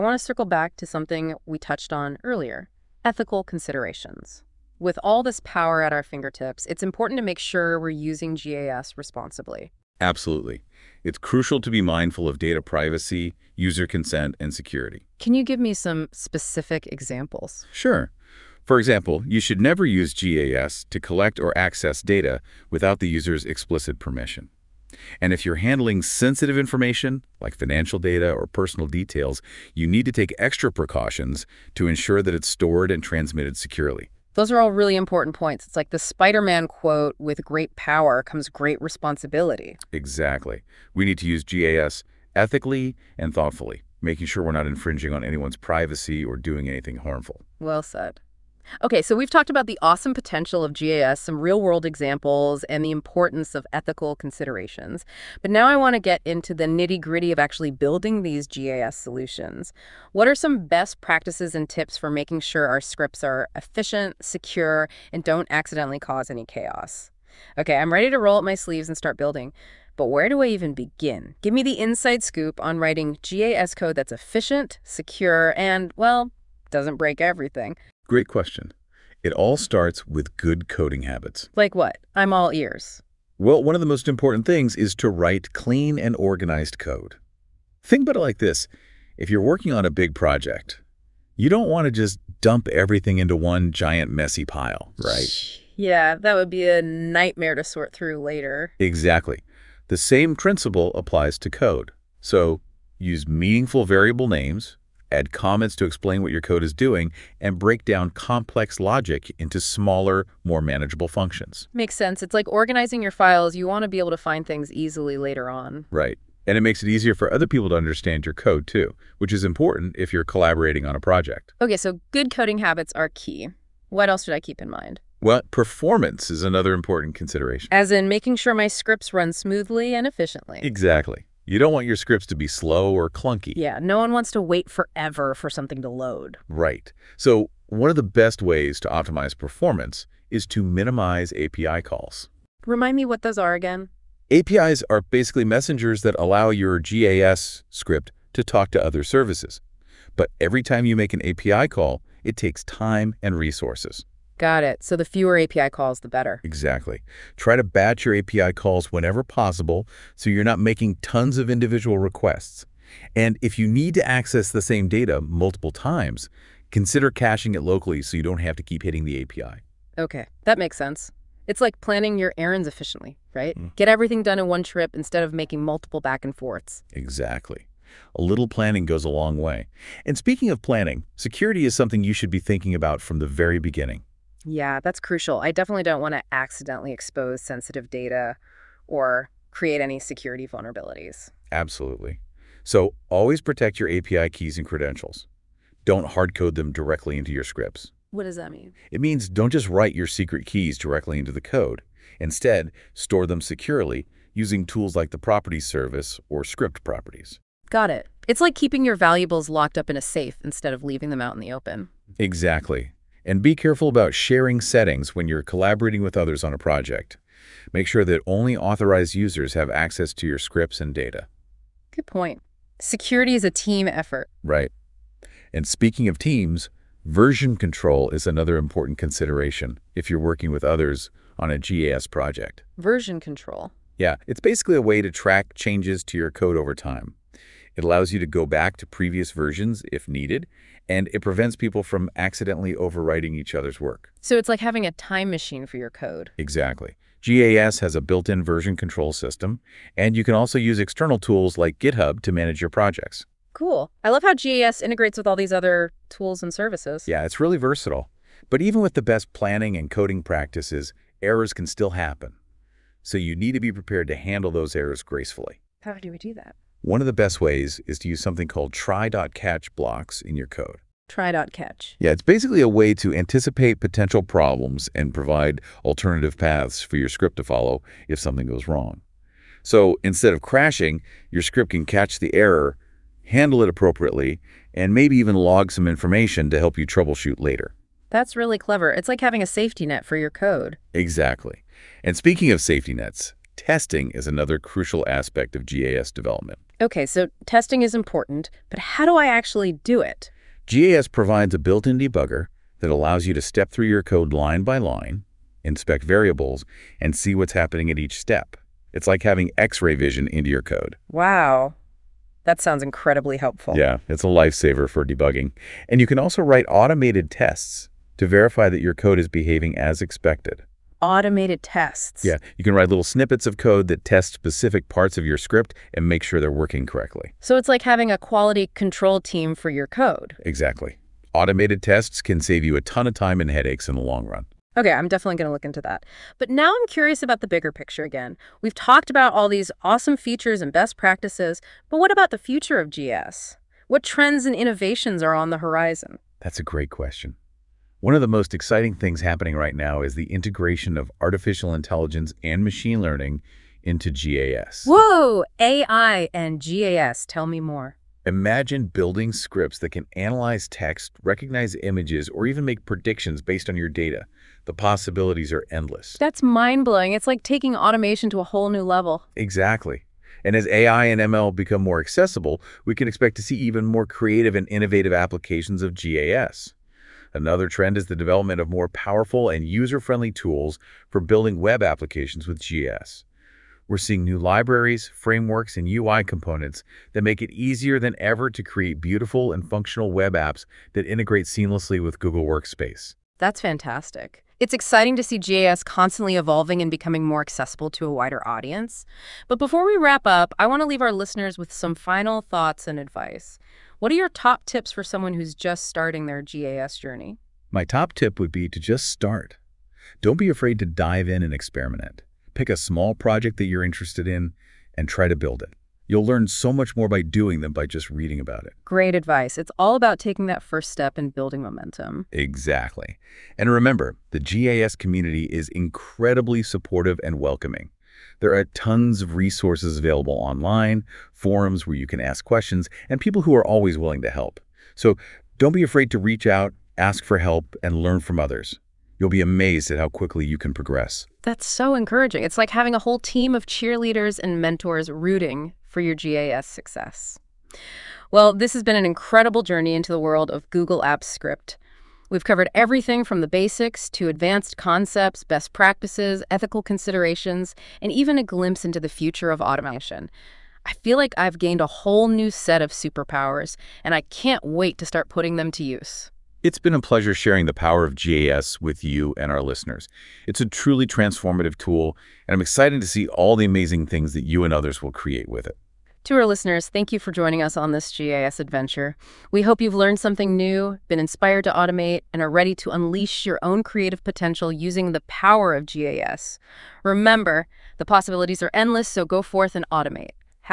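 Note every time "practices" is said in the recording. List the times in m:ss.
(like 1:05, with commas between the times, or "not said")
1:01, 4:20, 5:40, 7:35.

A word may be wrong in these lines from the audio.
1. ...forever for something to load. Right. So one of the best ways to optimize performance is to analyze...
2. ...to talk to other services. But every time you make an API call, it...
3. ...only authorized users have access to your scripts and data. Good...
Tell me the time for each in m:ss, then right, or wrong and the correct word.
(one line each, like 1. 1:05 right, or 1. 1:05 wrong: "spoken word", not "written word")
1. 2:14 wrong: "minimize", not "analyze"
2. 2:28 right
3. 3:38 right.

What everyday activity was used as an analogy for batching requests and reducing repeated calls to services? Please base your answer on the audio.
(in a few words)
planning your errands.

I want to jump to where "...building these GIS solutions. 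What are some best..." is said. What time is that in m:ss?
0:57.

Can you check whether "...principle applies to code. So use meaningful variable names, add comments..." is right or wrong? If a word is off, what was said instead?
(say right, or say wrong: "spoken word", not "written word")
right.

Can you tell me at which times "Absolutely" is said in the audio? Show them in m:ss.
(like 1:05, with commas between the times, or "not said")
0:09, 3:11.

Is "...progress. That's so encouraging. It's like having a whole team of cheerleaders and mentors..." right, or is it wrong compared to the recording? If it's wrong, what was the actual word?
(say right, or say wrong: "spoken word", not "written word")
right.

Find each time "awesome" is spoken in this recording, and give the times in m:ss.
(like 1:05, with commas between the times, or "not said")
0:49, 5:39.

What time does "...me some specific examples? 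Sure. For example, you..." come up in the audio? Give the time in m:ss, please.
0:15.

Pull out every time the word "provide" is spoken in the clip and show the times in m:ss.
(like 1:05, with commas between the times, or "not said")
4:35, 5:01.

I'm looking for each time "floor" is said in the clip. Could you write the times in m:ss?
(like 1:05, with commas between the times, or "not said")
not said.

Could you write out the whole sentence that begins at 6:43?
What are your top tips for someone who's just starting their GAS journey?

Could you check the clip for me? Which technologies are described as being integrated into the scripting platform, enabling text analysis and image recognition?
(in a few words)
artificial intelligence and machine learning.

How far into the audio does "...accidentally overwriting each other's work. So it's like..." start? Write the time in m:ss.
4:02.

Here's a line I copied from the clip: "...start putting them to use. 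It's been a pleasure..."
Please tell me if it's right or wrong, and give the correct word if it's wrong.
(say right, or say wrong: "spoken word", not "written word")
right.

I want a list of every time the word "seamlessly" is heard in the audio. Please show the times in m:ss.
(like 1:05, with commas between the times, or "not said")
6:31.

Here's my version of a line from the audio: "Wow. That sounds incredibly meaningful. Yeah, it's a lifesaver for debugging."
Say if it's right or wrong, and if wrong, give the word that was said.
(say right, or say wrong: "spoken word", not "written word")
wrong: "helpful", not "meaningful".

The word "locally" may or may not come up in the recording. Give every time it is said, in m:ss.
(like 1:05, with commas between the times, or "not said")
2:47.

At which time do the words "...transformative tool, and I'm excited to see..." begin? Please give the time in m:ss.
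7:51.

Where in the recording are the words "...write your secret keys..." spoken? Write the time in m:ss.
3:19.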